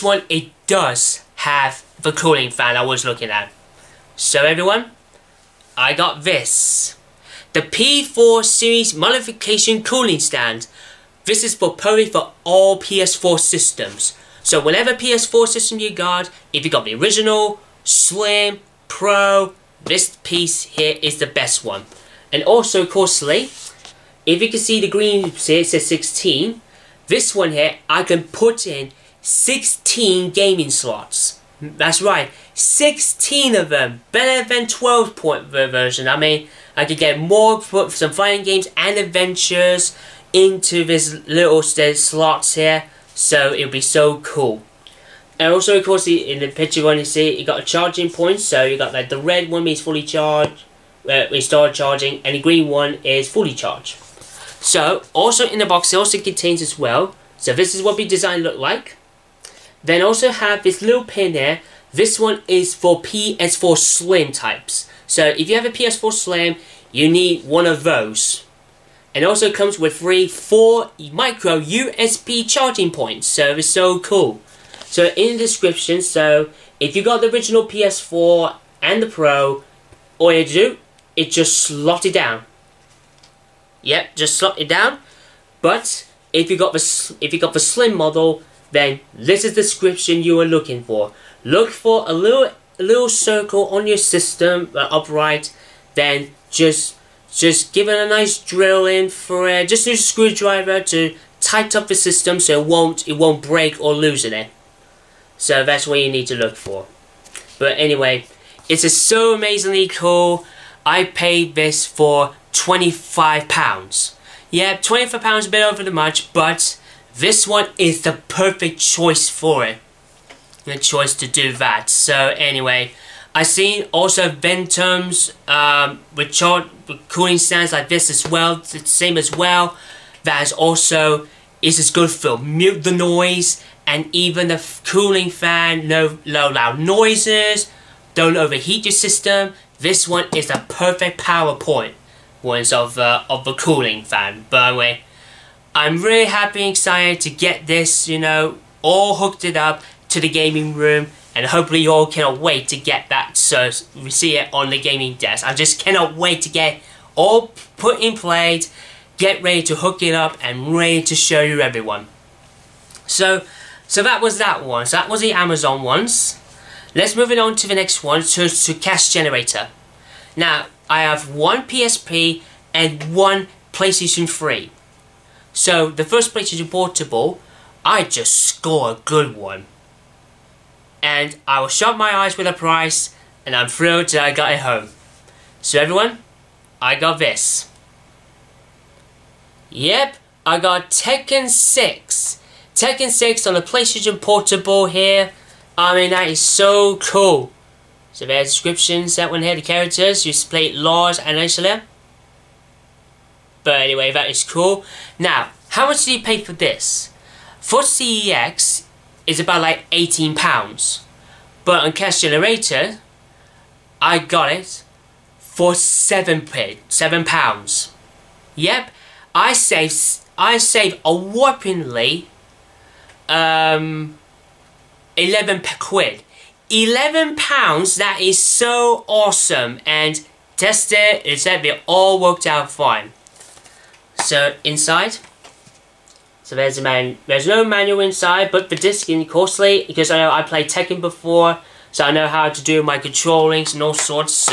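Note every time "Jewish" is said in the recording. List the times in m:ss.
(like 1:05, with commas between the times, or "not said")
not said.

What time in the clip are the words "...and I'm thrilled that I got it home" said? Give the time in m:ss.
3:03.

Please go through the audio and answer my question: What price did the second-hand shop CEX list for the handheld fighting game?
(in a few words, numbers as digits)
£18.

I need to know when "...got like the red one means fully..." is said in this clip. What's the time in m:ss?
0:48.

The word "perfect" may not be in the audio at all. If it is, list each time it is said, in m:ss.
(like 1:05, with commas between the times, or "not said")
1:58, 2:20.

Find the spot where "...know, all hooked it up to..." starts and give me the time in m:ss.
2:28.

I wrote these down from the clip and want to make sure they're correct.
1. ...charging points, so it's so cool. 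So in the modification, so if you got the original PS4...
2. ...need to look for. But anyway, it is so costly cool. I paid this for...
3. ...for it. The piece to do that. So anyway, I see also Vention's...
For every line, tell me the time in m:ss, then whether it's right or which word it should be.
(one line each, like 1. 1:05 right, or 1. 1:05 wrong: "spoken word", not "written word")
1. 1:12 wrong: "description", not "modification"
2. 1:46 wrong: "amazingly", not "costly"
3. 1:59 wrong: "choice", not "piece".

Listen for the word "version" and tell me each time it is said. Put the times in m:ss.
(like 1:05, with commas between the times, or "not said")
0:35.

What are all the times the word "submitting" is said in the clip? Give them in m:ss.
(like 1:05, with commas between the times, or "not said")
not said.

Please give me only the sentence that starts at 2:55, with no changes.
So the first place is reportable.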